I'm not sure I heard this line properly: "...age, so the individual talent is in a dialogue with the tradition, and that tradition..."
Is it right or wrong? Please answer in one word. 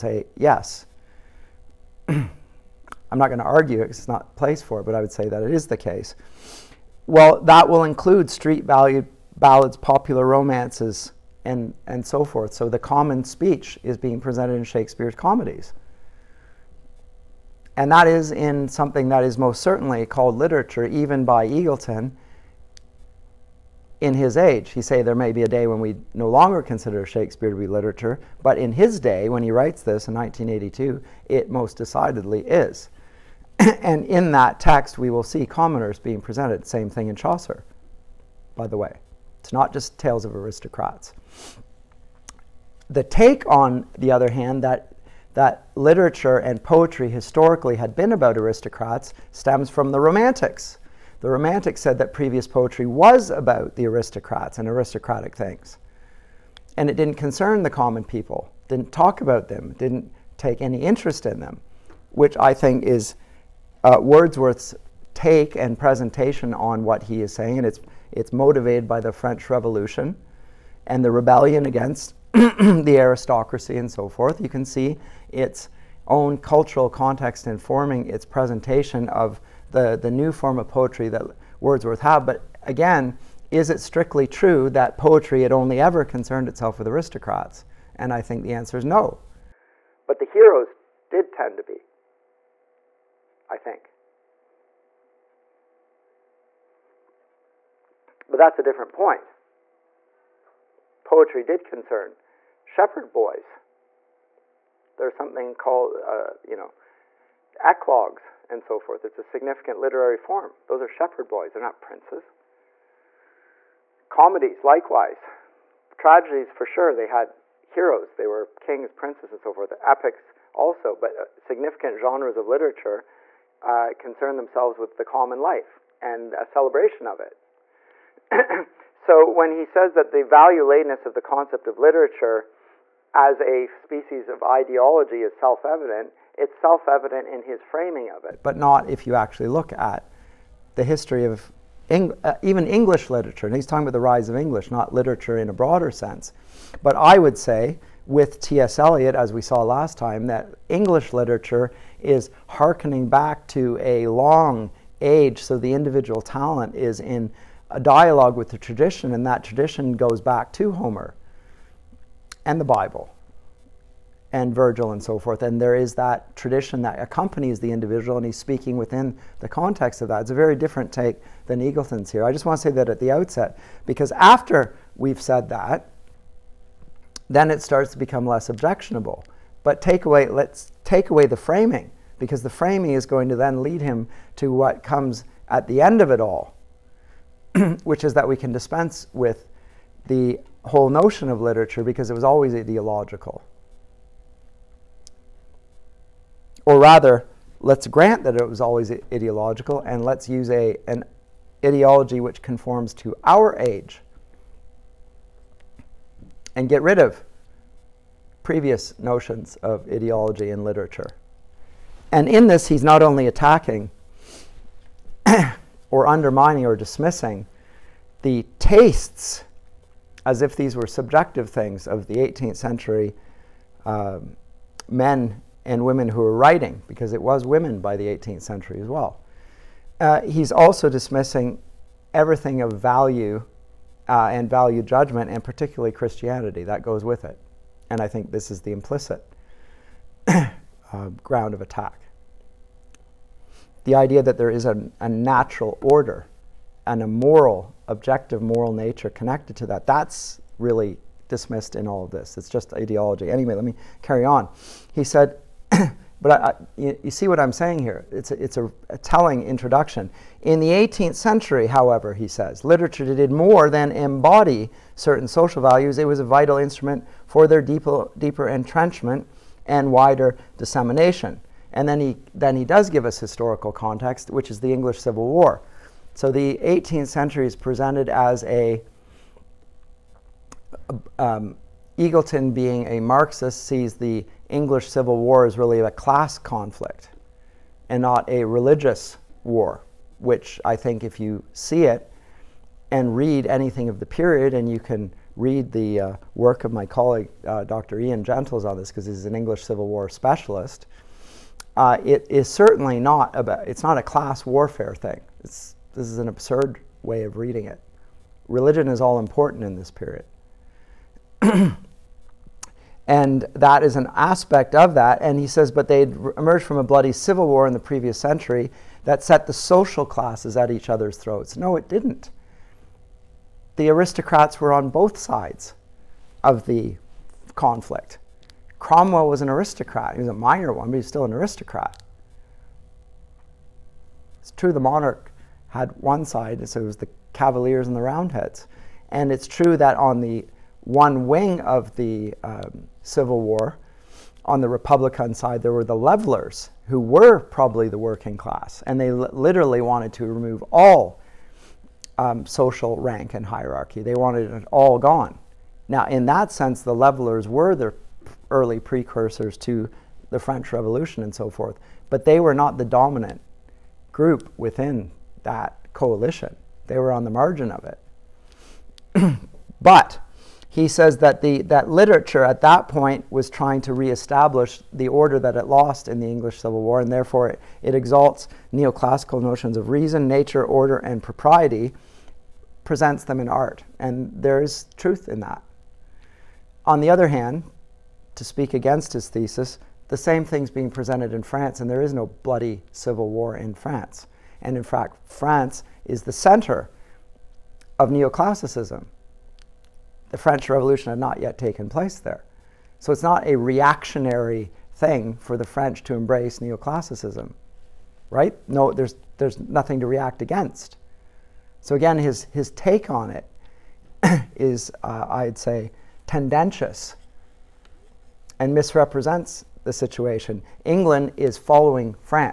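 right.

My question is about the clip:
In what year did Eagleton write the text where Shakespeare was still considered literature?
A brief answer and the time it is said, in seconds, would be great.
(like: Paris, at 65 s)
1982, at 30 s.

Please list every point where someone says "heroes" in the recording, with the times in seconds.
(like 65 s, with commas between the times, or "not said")
90 s, 117 s.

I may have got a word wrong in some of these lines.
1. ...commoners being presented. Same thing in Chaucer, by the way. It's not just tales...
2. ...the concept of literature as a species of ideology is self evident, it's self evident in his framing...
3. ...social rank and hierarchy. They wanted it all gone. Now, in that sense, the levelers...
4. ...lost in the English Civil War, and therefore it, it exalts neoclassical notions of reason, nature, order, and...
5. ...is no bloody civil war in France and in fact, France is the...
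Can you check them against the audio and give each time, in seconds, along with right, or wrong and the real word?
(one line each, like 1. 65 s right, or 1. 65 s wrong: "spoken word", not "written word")
1. 35 s right
2. 131 s right
3. 352 s right
4. 375 s right
5. 392 s right.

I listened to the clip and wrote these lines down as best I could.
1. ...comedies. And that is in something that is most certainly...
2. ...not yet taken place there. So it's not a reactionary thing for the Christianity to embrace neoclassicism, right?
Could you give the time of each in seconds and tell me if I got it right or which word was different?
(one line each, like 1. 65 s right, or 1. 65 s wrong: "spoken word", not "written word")
1. 15 s right
2. 401 s wrong: "French", not "Christianity".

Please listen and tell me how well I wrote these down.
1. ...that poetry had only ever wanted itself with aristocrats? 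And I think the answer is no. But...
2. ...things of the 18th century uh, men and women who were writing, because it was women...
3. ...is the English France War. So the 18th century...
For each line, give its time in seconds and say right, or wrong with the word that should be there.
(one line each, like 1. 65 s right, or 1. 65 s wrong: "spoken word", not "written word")
1. 84 s wrong: "concerned", not "wanted"
2. 221 s right
3. 274 s wrong: "Civil", not "France".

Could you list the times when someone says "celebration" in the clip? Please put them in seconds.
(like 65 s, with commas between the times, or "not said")
126 s.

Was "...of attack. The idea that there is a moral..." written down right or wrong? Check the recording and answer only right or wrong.
wrong.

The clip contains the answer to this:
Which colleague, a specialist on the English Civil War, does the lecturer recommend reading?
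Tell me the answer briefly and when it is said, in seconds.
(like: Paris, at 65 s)
Dr. Ian Gentles, at 297 s.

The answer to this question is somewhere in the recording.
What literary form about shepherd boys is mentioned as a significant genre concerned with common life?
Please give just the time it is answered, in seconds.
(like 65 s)
107 s.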